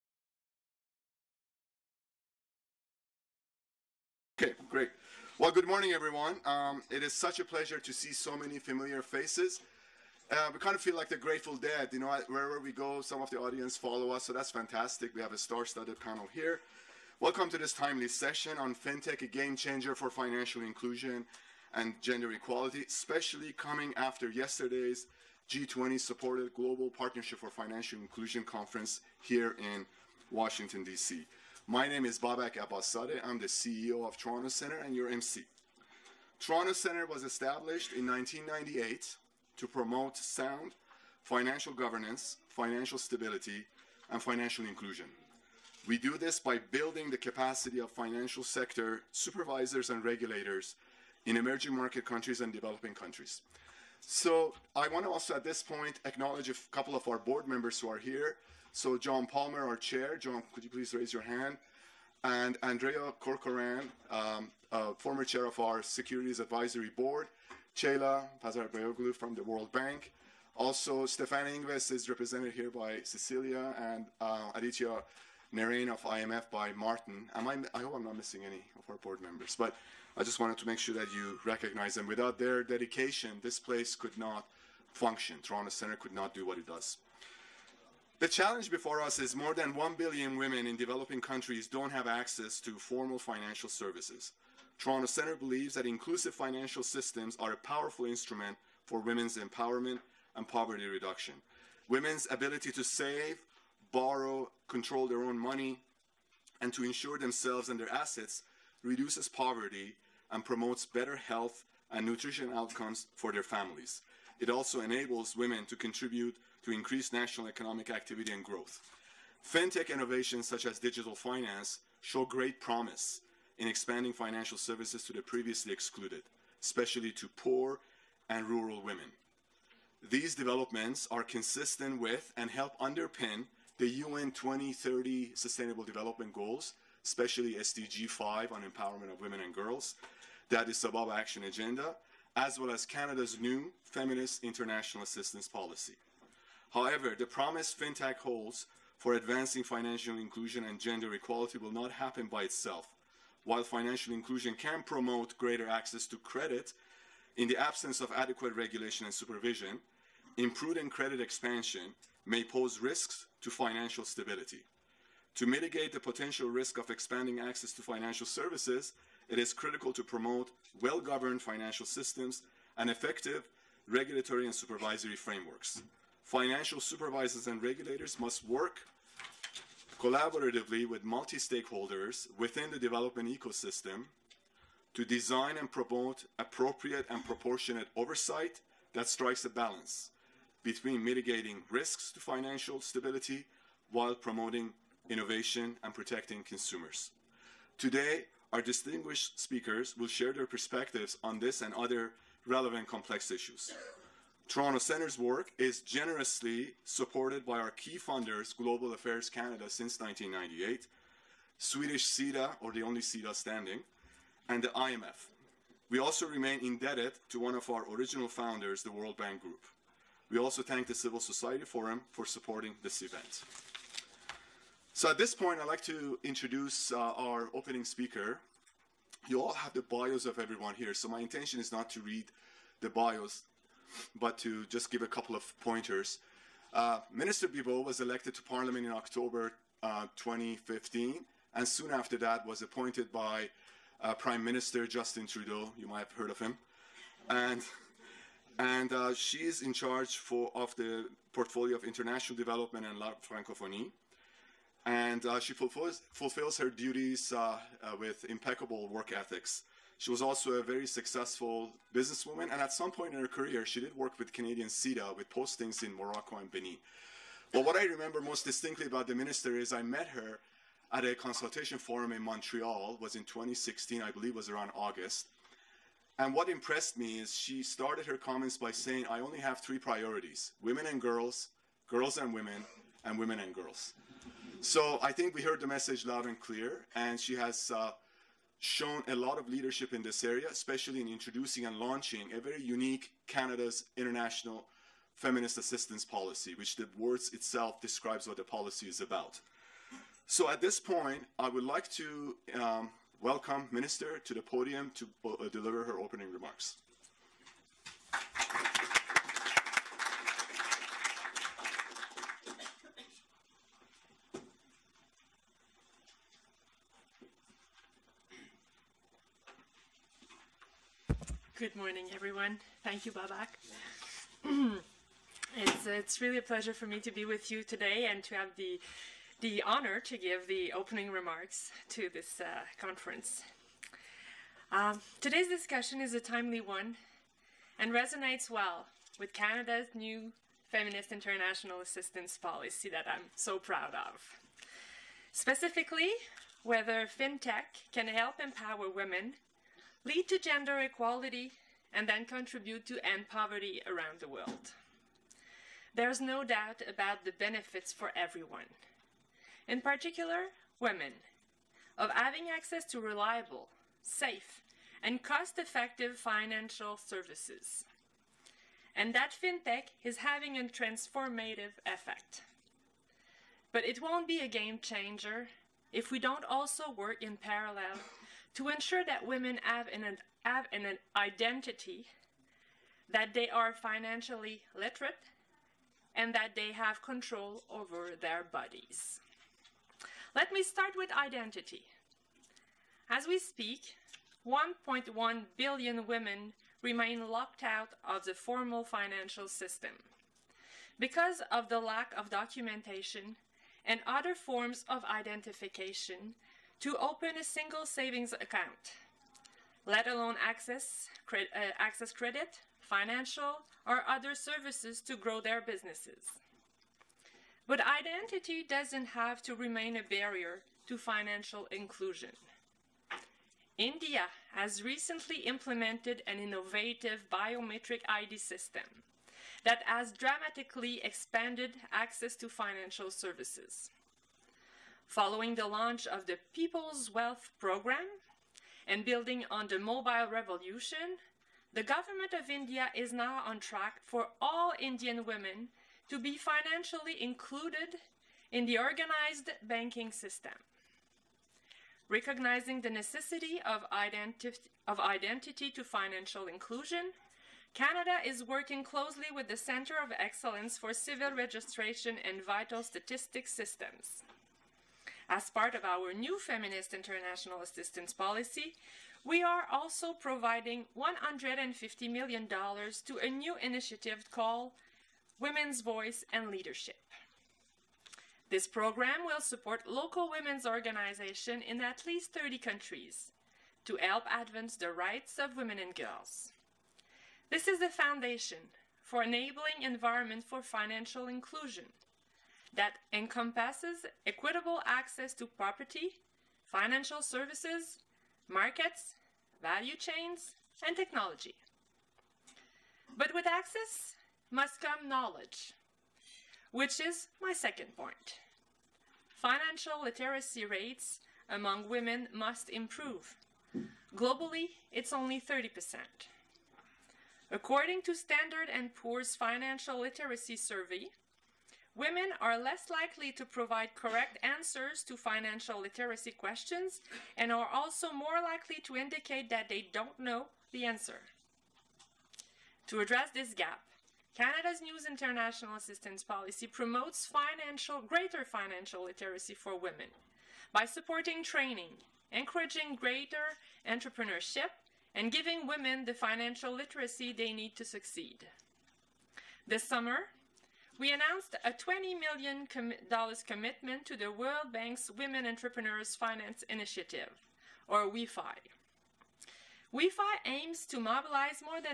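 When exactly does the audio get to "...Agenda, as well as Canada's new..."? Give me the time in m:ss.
2:21.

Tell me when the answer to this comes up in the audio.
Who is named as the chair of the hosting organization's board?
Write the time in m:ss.
0:58.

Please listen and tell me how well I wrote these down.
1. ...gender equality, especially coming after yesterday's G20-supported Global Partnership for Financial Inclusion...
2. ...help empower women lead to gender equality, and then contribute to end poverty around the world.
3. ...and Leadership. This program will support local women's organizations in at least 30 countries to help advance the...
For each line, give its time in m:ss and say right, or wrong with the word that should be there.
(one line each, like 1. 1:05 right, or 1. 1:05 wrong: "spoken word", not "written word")
1. 0:22 right
2. 5:48 right
3. 7:56 right.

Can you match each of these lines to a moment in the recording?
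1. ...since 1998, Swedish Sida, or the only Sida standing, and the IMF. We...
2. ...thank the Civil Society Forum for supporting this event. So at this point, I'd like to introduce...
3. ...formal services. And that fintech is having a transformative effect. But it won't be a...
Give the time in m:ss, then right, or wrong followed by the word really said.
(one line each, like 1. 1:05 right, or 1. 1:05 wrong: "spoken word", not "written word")
1. 3:29 right
2. 3:40 right
3. 6:06 wrong: "financial", not "formal".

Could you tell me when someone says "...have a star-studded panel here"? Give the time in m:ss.
0:15.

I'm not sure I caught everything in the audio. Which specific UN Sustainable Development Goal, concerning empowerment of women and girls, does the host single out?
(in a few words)
SDG 5.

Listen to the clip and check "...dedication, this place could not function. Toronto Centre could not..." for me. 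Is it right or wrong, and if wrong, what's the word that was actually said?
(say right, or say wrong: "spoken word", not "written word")
right.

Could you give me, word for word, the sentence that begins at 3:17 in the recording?
Today, our distinguished speakers will share their perspectives on this and other relevant complex issues.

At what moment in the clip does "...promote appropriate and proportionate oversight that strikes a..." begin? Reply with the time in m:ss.
3:05.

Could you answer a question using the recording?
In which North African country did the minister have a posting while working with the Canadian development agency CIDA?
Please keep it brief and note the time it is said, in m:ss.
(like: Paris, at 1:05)
Morocco, at 4:25.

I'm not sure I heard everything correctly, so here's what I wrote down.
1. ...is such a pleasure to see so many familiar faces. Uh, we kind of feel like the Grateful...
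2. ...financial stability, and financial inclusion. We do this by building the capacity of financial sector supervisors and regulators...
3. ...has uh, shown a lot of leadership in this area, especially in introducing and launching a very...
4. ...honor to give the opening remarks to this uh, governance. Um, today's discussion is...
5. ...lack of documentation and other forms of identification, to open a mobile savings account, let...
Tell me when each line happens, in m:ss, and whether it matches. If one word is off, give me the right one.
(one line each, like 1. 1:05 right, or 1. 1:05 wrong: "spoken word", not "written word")
1. 0:07 right
2. 0:42 right
3. 4:47 right
4. 5:29 wrong: "conference", not "governance"
5. 6:41 wrong: "single", not "mobile".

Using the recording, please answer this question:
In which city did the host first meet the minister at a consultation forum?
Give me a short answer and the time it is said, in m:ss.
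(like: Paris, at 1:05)
Montreal, at 4:32.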